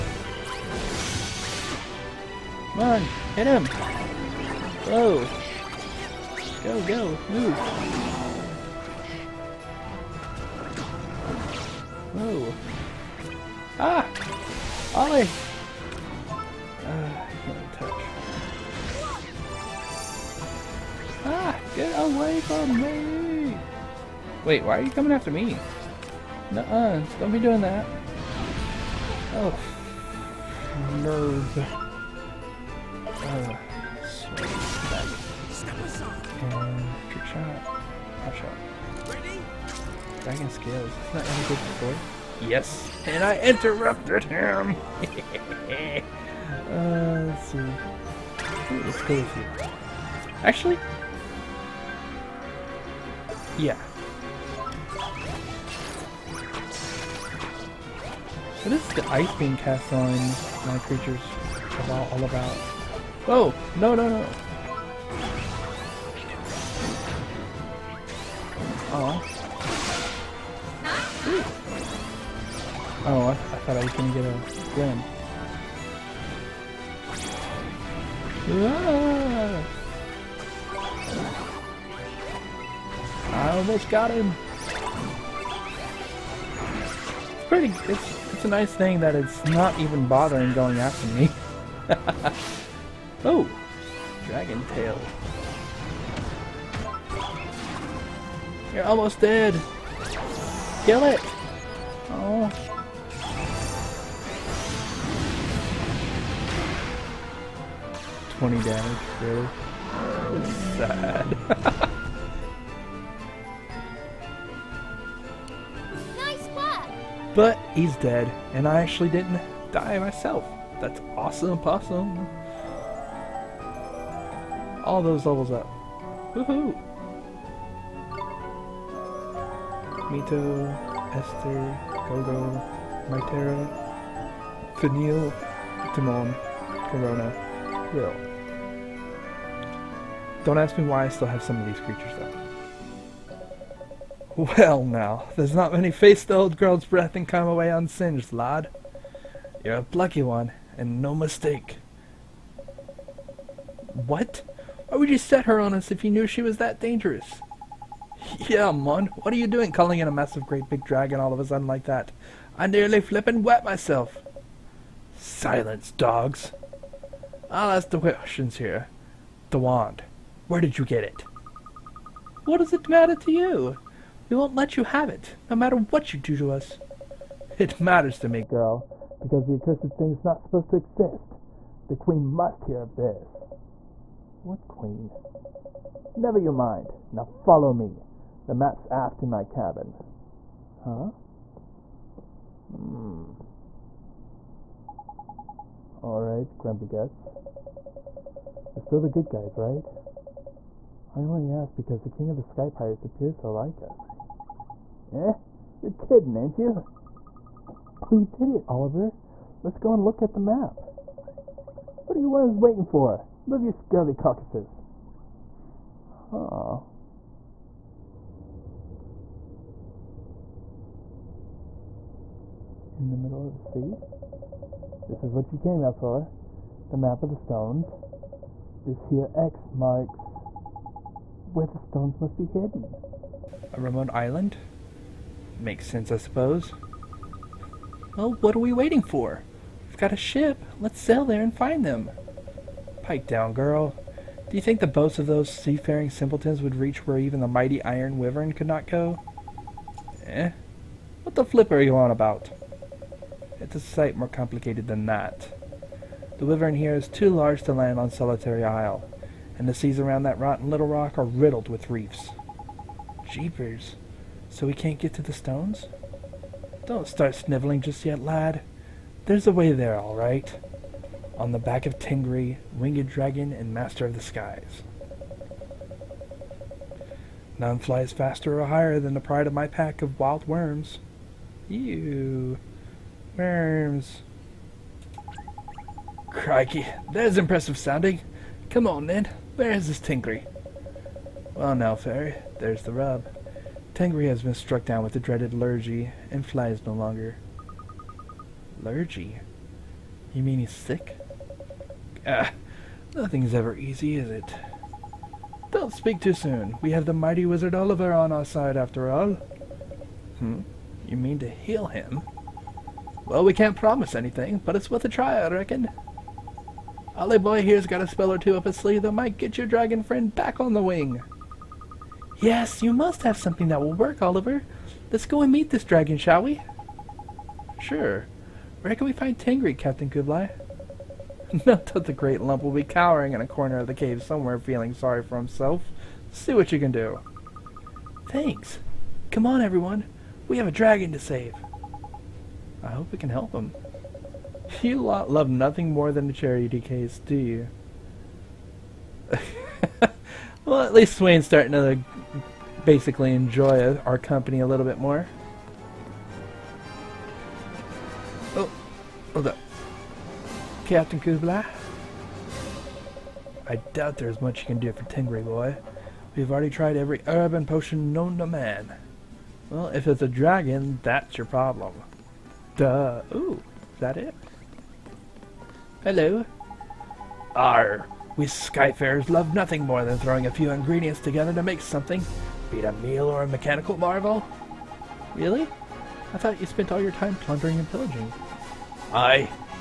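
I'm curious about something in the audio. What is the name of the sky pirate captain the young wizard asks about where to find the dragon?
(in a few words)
Captain Kublai.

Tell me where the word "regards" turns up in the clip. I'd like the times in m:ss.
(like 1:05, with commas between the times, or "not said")
not said.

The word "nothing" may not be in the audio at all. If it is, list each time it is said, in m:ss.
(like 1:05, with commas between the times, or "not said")
5:03, 5:45, 6:19.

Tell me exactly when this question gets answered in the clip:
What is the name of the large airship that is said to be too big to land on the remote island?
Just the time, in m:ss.
4:07.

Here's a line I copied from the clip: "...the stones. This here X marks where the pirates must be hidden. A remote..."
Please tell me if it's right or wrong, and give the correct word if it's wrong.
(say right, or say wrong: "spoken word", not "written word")
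wrong: "stones", not "pirates".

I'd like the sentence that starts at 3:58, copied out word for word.
Well, what are we waiting for?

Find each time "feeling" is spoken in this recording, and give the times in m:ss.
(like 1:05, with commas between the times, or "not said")
5:34.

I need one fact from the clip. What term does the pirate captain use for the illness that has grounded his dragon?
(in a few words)
the dreaded lurgy.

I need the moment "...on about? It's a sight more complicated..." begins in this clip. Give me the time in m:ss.
4:11.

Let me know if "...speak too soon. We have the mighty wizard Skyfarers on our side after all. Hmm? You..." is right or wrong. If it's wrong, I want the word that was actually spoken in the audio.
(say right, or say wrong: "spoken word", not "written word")
wrong: "Oliver", not "Skyfarers".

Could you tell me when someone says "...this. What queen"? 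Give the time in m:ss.
3:02.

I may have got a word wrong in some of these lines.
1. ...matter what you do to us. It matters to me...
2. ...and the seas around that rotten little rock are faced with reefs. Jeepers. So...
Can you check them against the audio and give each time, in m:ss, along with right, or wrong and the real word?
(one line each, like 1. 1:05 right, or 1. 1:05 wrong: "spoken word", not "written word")
1. 2:55 right
2. 4:19 wrong: "riddled", not "faced".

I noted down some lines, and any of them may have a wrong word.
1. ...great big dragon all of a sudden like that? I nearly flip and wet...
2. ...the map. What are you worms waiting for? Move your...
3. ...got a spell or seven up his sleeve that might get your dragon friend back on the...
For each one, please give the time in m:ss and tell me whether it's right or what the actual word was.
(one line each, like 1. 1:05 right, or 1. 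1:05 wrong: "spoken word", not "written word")
1. 2:40 right
2. 3:30 right
3. 5:17 wrong: "two", not "seven".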